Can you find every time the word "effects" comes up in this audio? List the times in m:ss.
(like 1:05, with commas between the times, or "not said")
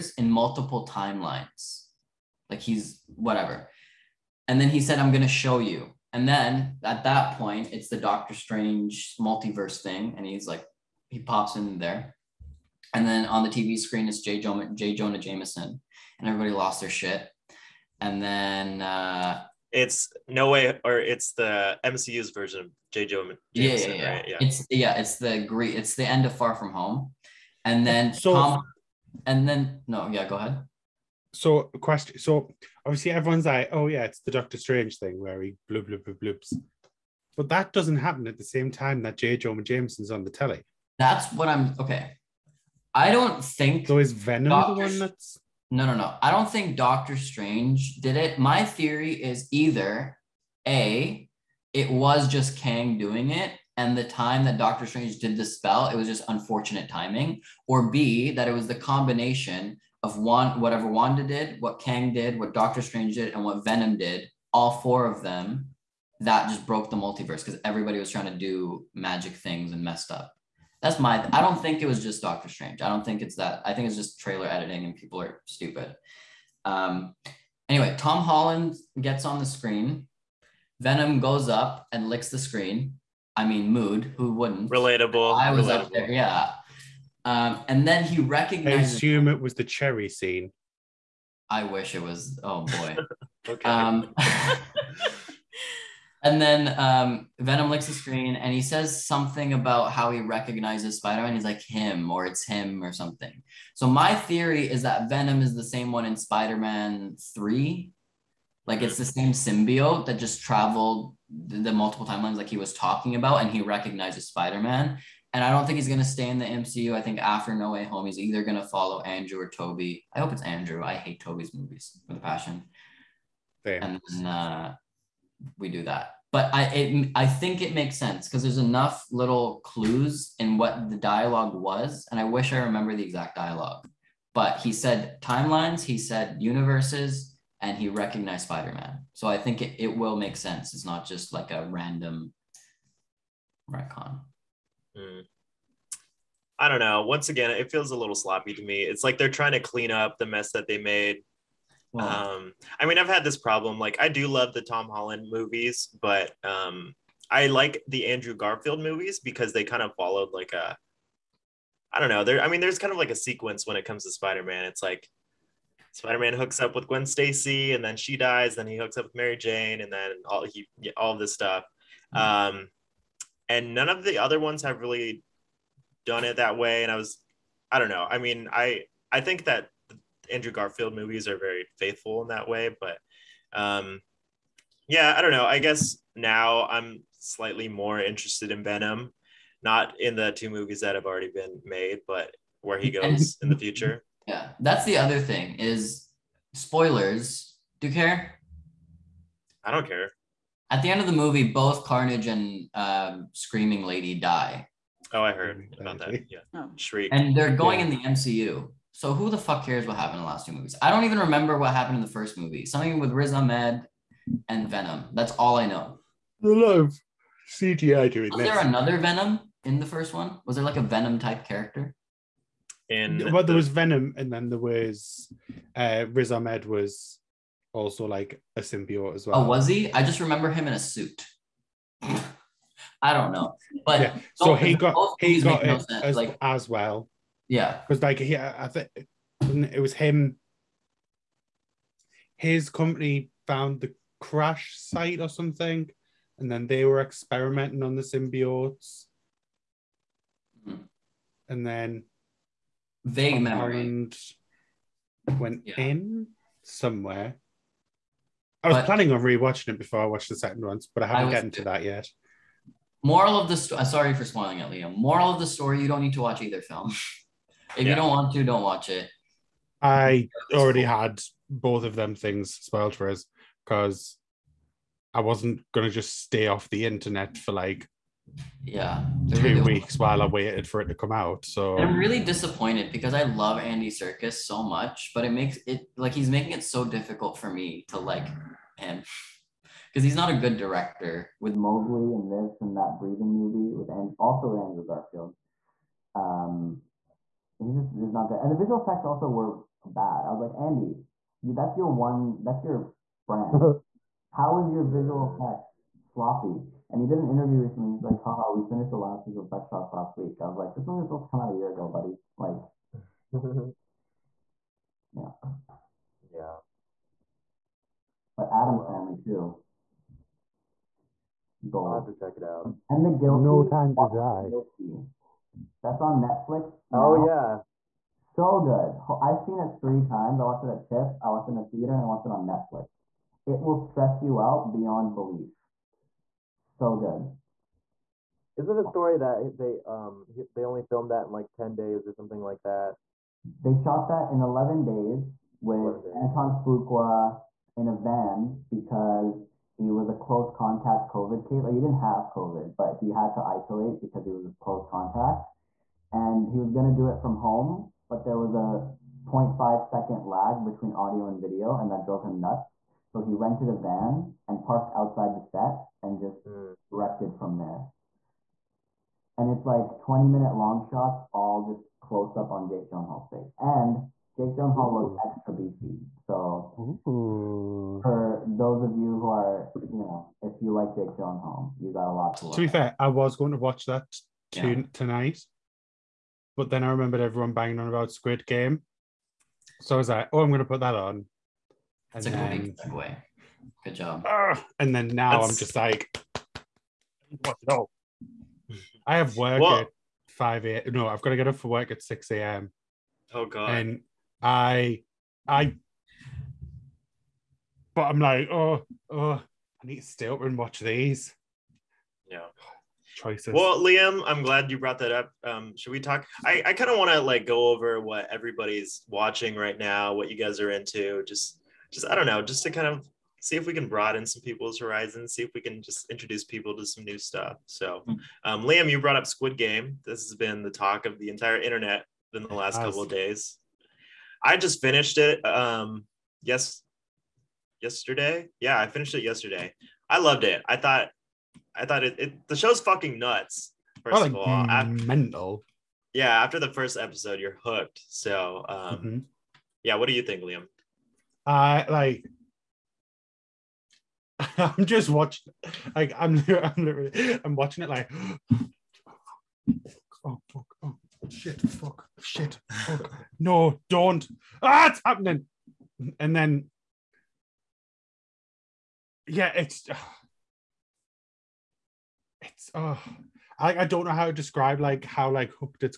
4:58, 5:05, 5:09.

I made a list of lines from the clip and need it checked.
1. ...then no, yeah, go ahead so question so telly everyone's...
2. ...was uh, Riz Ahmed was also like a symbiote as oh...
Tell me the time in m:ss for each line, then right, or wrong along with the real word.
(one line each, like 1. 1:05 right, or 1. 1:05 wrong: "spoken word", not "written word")
1. 0:29 wrong: "obviously", not "telly"
2. 3:44 right.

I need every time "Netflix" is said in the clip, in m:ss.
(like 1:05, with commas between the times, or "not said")
5:26, 5:32.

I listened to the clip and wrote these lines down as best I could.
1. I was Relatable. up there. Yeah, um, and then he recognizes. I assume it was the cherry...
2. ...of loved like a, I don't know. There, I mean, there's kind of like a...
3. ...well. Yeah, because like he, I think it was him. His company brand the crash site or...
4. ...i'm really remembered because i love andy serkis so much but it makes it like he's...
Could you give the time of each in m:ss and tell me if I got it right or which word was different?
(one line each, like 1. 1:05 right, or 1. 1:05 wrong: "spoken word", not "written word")
1. 1:25 right
2. 2:39 wrong: "followed", not "loved"
3. 3:56 wrong: "found", not "brand"
4. 4:41 wrong: "disappointed", not "remembered".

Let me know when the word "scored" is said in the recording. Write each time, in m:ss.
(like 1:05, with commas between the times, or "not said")
not said.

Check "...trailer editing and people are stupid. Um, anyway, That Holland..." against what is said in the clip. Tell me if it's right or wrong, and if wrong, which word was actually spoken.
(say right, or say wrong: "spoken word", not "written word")
wrong: "Tom", not "That".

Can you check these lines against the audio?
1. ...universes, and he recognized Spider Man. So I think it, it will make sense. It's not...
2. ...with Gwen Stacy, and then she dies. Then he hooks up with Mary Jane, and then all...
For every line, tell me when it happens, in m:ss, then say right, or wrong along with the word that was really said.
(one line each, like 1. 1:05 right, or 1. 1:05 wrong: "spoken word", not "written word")
1. 2:16 right
2. 2:46 right.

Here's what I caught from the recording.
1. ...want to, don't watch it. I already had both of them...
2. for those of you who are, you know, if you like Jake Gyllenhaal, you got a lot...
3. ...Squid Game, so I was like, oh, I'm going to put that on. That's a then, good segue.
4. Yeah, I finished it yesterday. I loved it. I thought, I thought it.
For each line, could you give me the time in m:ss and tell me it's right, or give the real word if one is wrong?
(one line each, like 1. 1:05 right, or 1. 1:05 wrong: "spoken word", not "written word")
1. 4:28 right
2. 6:18 right
3. 6:28 right
4. 7:18 right.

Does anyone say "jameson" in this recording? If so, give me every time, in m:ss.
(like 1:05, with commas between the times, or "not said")
0:15, 0:23, 0:39.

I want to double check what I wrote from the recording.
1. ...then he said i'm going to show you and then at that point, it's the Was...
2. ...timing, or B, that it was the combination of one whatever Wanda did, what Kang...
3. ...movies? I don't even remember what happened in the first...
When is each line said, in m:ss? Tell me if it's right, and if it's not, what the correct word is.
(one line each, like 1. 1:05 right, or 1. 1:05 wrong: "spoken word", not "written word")
1. 0:04 wrong: "Doctor", not "Was"
2. 0:56 right
3. 3:30 right.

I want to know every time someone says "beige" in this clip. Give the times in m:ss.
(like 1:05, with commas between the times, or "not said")
not said.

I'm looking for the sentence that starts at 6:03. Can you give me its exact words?
So he rented a van and parked outside the set and just mm.